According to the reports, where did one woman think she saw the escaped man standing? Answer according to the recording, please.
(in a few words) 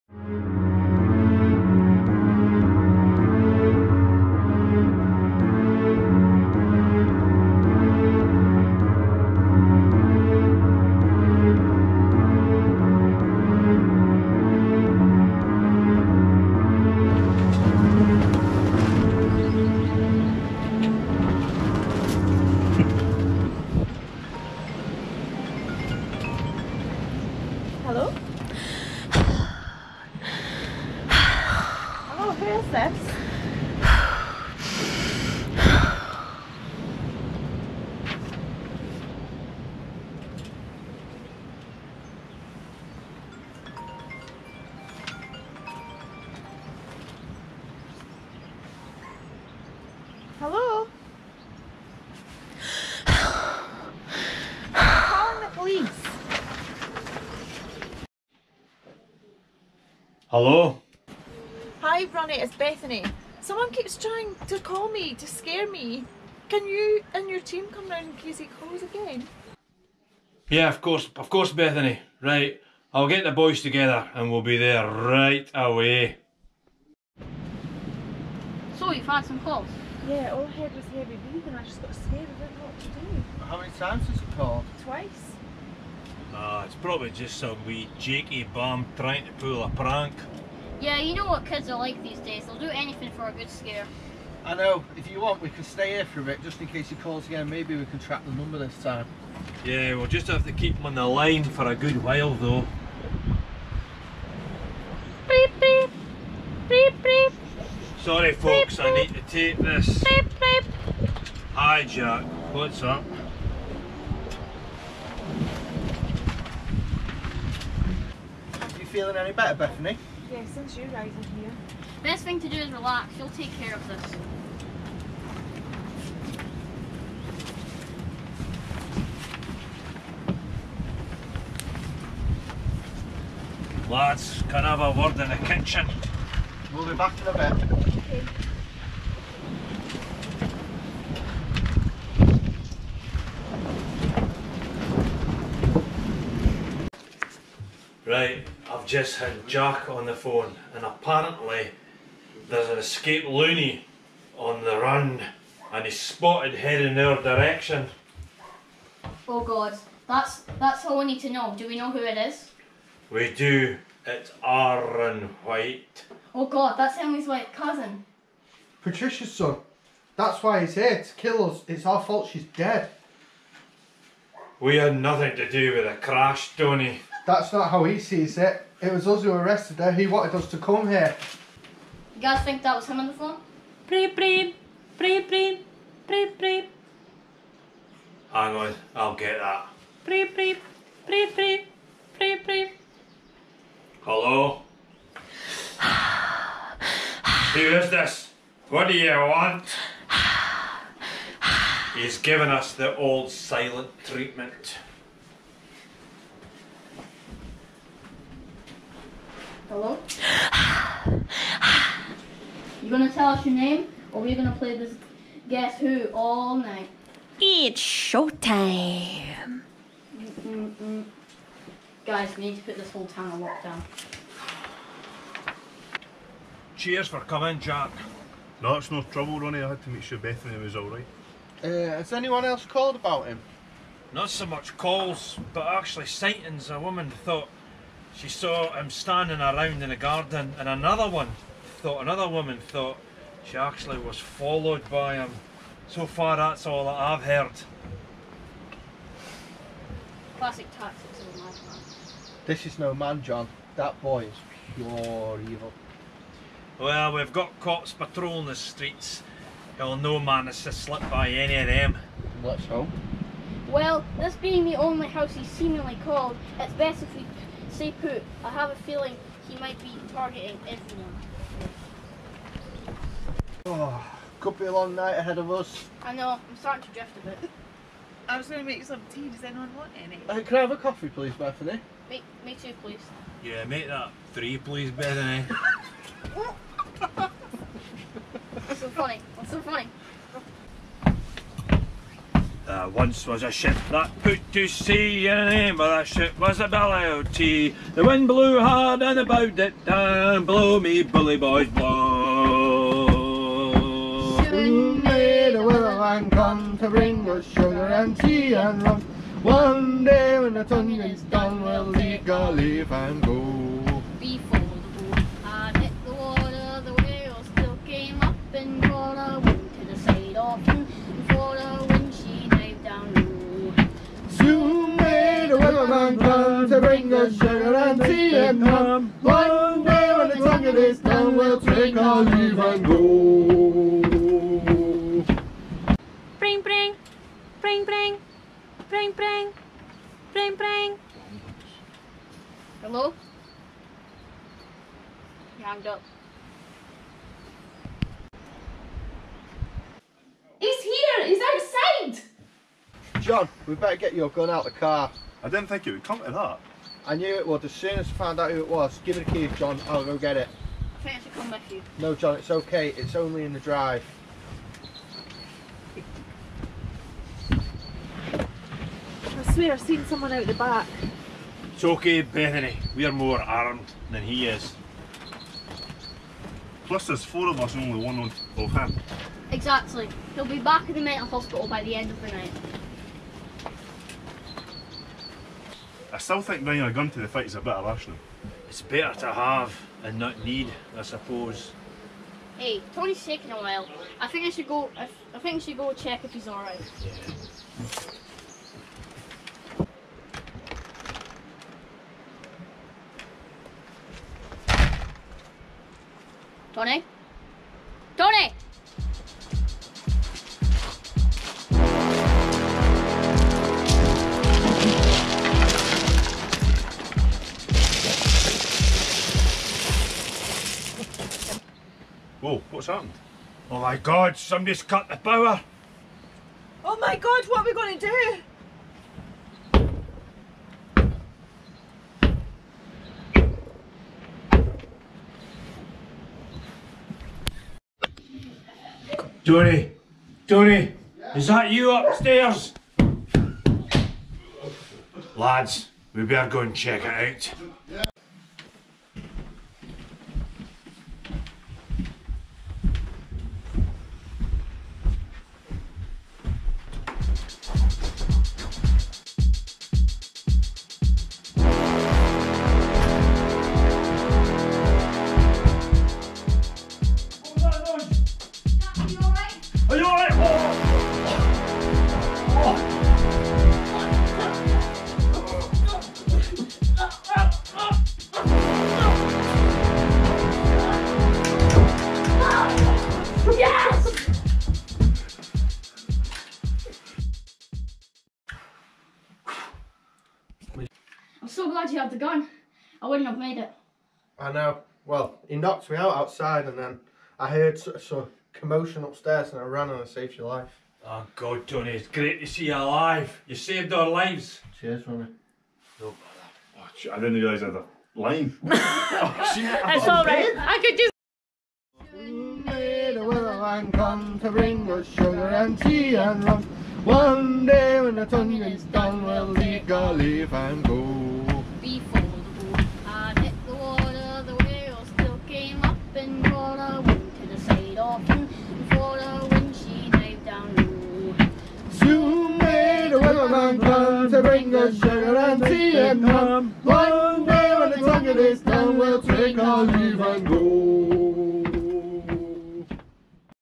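In the garden.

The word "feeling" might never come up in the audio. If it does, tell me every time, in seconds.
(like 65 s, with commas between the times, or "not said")
118 s, 268 s.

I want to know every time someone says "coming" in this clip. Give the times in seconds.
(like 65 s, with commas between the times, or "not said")
227 s, 361 s.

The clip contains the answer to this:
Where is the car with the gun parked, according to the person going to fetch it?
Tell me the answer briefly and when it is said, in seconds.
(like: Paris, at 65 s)
In the drive, at 363 s.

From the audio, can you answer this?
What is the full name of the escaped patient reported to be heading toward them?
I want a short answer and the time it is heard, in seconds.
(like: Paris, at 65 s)
Aaron White, at 164 s.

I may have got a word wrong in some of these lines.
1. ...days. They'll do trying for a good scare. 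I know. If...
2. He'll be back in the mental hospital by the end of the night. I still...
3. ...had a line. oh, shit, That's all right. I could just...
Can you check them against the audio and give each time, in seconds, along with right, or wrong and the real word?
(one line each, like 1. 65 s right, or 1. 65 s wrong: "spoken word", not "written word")
1. 92 s wrong: "anything", not "trying"
2. 380 s right
3. 507 s right.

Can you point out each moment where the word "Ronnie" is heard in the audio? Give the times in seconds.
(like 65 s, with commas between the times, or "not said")
62 s, 229 s, 505 s.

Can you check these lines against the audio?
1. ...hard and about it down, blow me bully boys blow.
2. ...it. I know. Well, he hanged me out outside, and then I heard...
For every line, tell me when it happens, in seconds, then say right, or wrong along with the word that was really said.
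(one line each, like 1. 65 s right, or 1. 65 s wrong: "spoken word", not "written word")
1. 298 s right
2. 493 s wrong: "knocked", not "hanged".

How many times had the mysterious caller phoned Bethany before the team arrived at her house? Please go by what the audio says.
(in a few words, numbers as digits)
Twice.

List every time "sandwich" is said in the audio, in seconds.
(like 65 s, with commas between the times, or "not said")
not said.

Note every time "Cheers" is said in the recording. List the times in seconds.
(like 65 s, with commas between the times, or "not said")
226 s, 504 s.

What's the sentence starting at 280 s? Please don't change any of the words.
Uh, can I have a coffee, please, Bethany?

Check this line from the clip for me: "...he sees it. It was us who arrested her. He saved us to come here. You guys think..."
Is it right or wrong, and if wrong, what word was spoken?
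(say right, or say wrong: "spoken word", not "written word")
wrong: "wanted", not "saved".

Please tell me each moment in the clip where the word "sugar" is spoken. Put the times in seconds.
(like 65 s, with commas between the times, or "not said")
307 s, 327 s, 515 s, 534 s.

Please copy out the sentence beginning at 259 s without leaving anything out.
He'll no man is to slip by any of them.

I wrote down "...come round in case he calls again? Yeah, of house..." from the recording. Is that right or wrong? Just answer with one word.
wrong.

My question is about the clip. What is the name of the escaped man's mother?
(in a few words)
Patricia.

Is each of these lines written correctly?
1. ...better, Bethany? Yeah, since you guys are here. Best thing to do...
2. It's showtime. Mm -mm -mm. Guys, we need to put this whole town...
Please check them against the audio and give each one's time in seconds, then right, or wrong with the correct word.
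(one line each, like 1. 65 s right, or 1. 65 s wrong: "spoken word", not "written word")
1. 119 s right
2. 217 s right.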